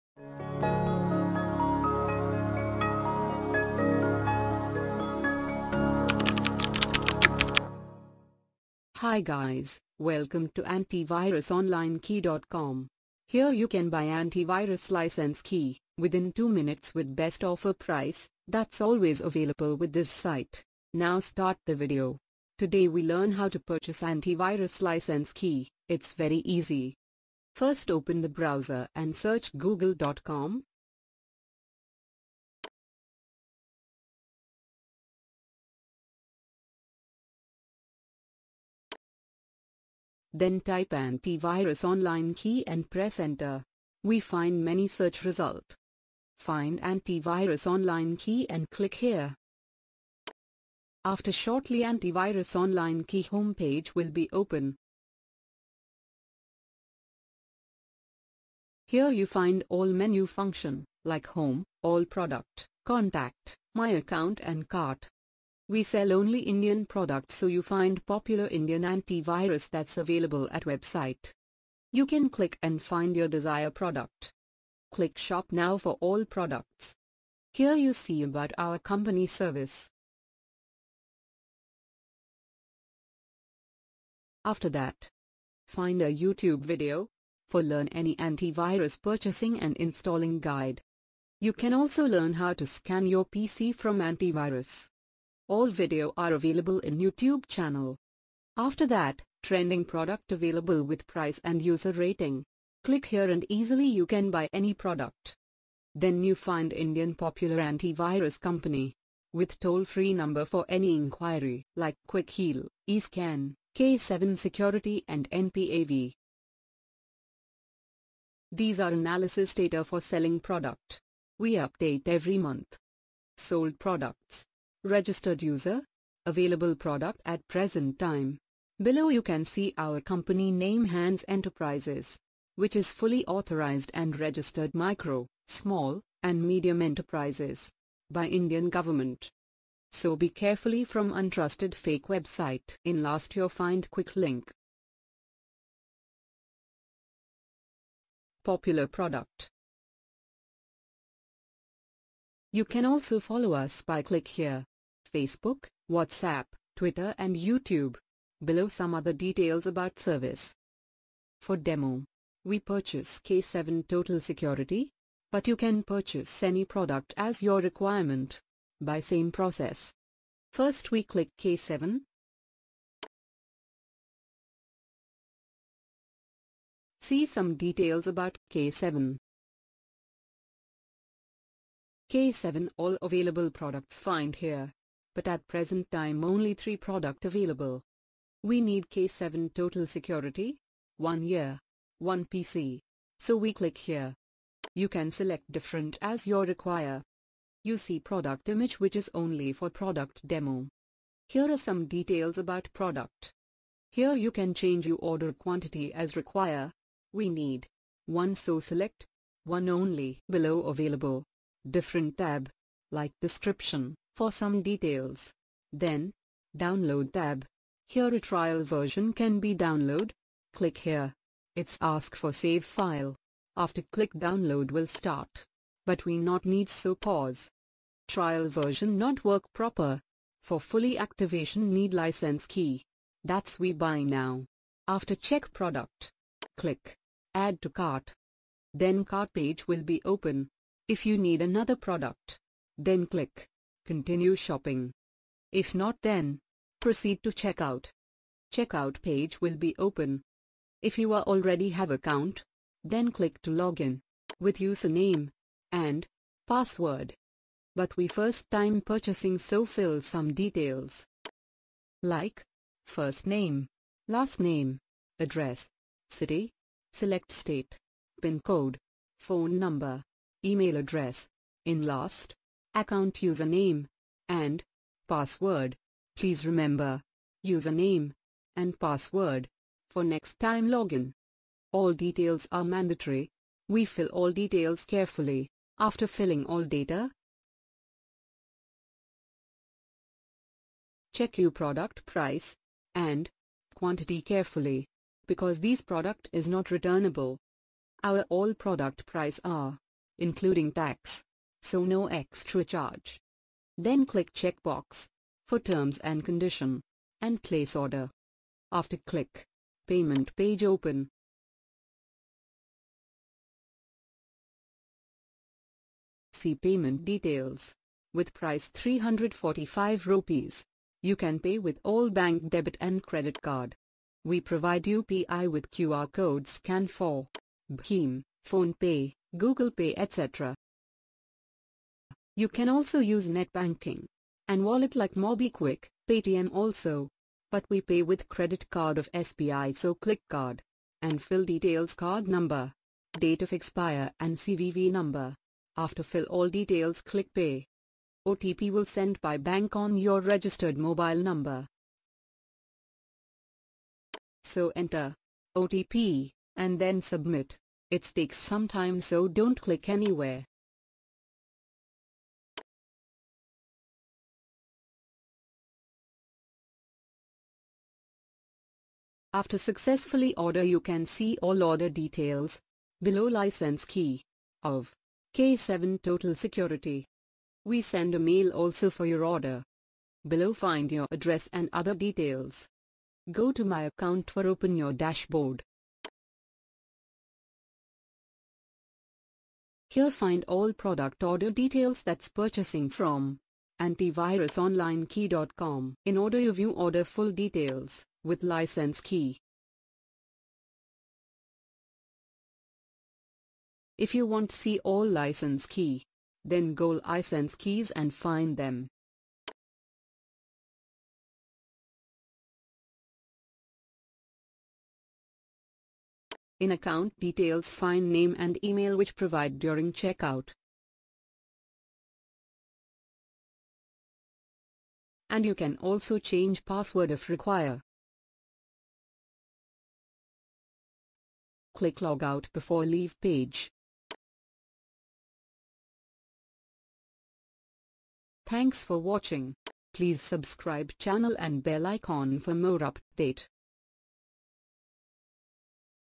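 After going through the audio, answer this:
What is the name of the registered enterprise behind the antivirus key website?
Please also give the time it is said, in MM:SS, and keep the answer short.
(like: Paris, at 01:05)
Hands Enterprises, at 02:10.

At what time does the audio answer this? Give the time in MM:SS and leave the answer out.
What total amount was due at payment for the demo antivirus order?
05:18.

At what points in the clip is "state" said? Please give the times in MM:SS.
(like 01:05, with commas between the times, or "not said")
04:27.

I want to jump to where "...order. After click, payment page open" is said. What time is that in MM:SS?
05:07.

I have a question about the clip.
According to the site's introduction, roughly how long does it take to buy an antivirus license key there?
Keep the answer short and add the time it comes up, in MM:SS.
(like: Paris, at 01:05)
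2 minutes, at 00:16.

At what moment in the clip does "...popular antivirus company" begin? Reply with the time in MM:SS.
01:47.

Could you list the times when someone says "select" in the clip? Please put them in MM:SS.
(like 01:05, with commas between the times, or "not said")
03:15, 03:28, 04:26.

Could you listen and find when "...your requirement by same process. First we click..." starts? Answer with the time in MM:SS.
02:47.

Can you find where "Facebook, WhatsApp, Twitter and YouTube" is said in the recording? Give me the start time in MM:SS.
02:35.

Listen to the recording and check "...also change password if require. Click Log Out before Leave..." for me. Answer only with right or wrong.
right.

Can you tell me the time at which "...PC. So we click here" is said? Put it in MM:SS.
03:12.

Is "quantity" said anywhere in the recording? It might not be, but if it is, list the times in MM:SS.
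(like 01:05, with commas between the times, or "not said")
03:25, 04:53.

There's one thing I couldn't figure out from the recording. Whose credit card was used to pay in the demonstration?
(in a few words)
SBI.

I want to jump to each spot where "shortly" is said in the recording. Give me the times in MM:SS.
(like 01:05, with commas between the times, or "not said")
00:51.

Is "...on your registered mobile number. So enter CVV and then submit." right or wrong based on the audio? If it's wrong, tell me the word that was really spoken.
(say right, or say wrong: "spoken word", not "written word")
wrong: "OTP", not "CVV".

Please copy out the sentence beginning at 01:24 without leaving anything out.
After that, find a YouTube video for learn any antivirus purchasing and installing guide.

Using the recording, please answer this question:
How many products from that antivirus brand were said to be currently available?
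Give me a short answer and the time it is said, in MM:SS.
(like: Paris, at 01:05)
3, at 03:06.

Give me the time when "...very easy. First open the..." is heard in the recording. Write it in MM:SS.
00:26.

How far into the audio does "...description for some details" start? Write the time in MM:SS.
03:33.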